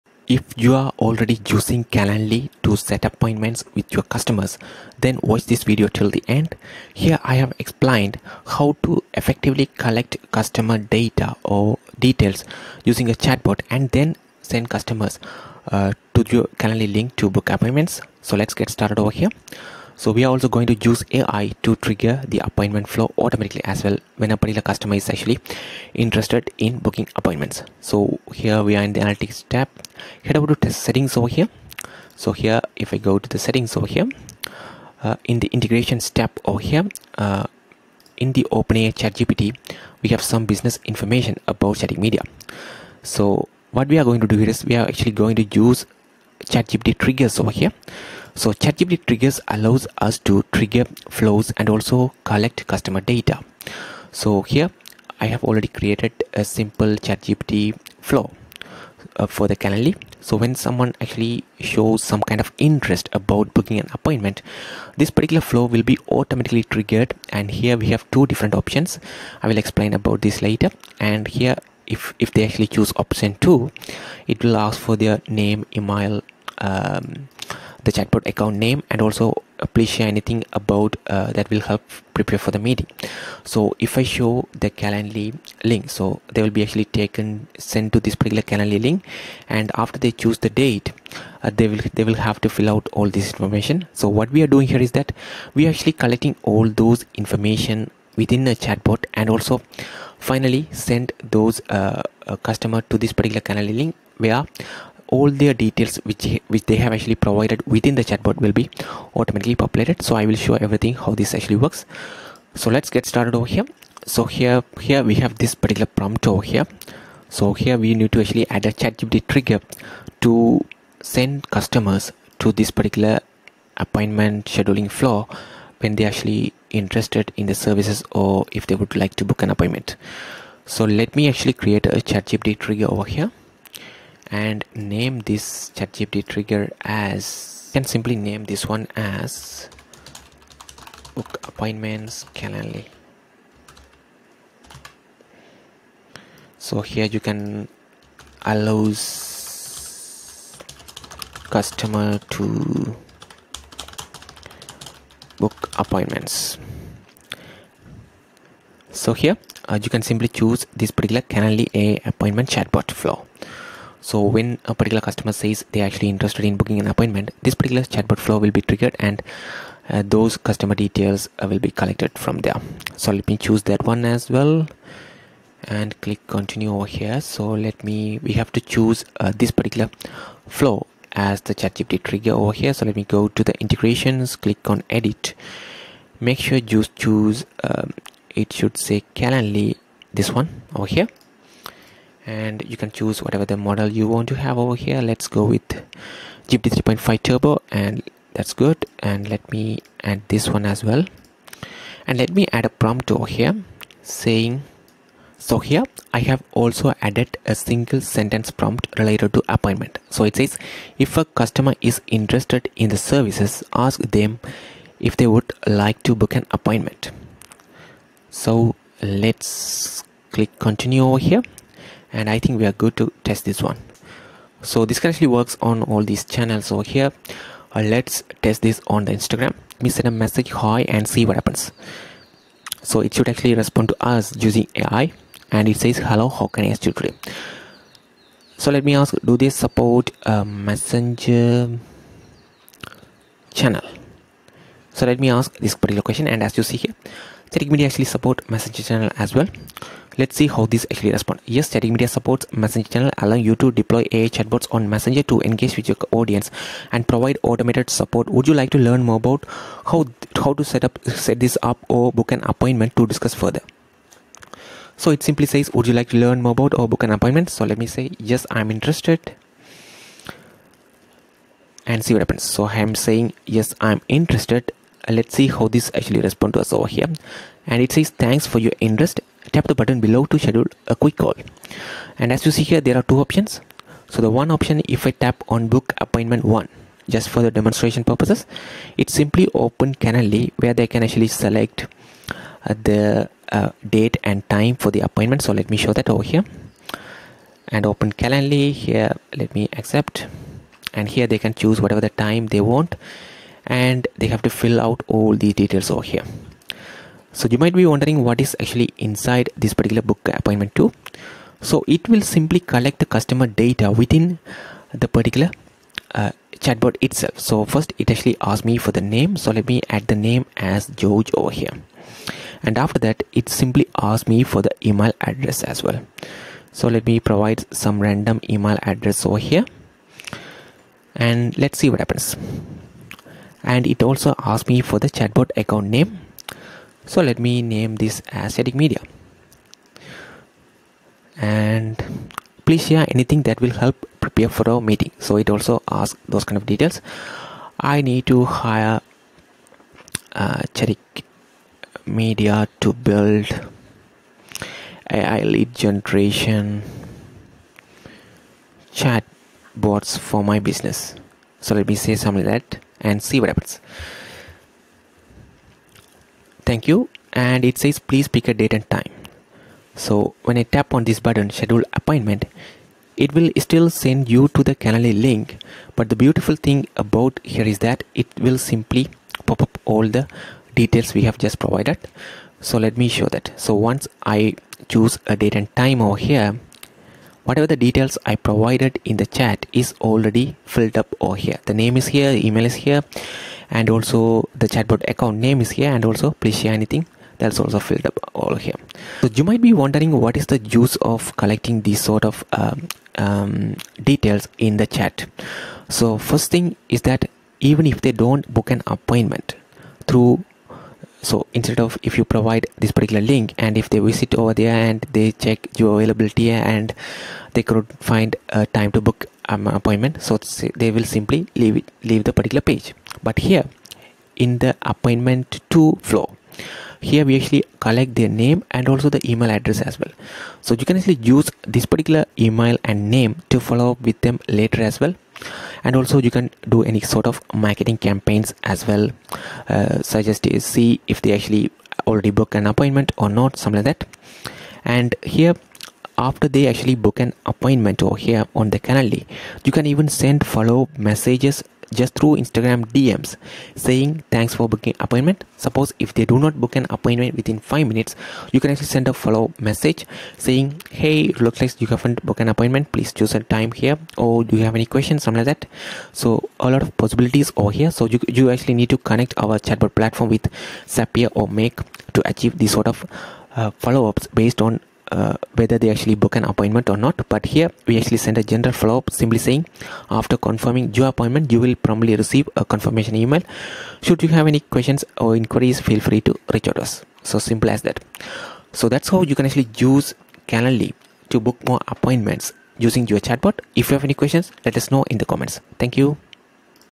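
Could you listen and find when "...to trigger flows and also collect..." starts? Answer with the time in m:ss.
0:50.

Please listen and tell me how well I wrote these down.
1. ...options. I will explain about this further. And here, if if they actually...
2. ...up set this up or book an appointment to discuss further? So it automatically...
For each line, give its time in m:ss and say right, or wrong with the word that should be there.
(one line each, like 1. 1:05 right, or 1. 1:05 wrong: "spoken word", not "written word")
1. 1:08 wrong: "later", not "further"
2. 4:20 wrong: "simply", not "automatically".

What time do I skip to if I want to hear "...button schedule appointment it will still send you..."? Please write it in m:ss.
6:11.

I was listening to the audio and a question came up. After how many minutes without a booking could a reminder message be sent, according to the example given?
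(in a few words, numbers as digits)
5.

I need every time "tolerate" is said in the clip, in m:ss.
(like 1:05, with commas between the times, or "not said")
not said.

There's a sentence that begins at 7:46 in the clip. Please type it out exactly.
So a lot of possibilities over here.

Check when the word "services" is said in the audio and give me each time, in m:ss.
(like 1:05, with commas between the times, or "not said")
2:07, 3:32.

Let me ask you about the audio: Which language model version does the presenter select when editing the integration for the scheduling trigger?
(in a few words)
GPT 3.5 turbo.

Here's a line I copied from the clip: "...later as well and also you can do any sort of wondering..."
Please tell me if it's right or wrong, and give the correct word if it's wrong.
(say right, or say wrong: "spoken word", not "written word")
wrong: "marketing", not "wondering".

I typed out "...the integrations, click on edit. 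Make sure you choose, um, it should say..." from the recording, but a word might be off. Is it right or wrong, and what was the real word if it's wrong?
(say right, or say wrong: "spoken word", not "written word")
right.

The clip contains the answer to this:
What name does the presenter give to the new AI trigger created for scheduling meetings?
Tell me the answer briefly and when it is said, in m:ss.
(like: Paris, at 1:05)
book appointments Calendly, at 2:21.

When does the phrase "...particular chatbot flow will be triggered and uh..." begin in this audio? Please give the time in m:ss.
2:47.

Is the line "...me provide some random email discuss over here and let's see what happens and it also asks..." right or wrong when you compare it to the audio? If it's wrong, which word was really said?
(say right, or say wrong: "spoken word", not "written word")
wrong: "address", not "discuss".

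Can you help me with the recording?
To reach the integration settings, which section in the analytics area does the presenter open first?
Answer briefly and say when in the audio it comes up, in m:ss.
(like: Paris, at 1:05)
test settings, at 0:30.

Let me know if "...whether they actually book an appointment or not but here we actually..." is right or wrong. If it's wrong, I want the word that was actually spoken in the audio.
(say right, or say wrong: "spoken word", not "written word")
right.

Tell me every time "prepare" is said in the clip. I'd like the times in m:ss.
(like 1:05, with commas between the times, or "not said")
1:22, 5:44.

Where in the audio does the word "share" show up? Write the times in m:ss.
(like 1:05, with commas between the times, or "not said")
1:19, 5:42, 6:36.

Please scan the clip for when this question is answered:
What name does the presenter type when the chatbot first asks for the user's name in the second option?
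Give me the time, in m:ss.
5:20.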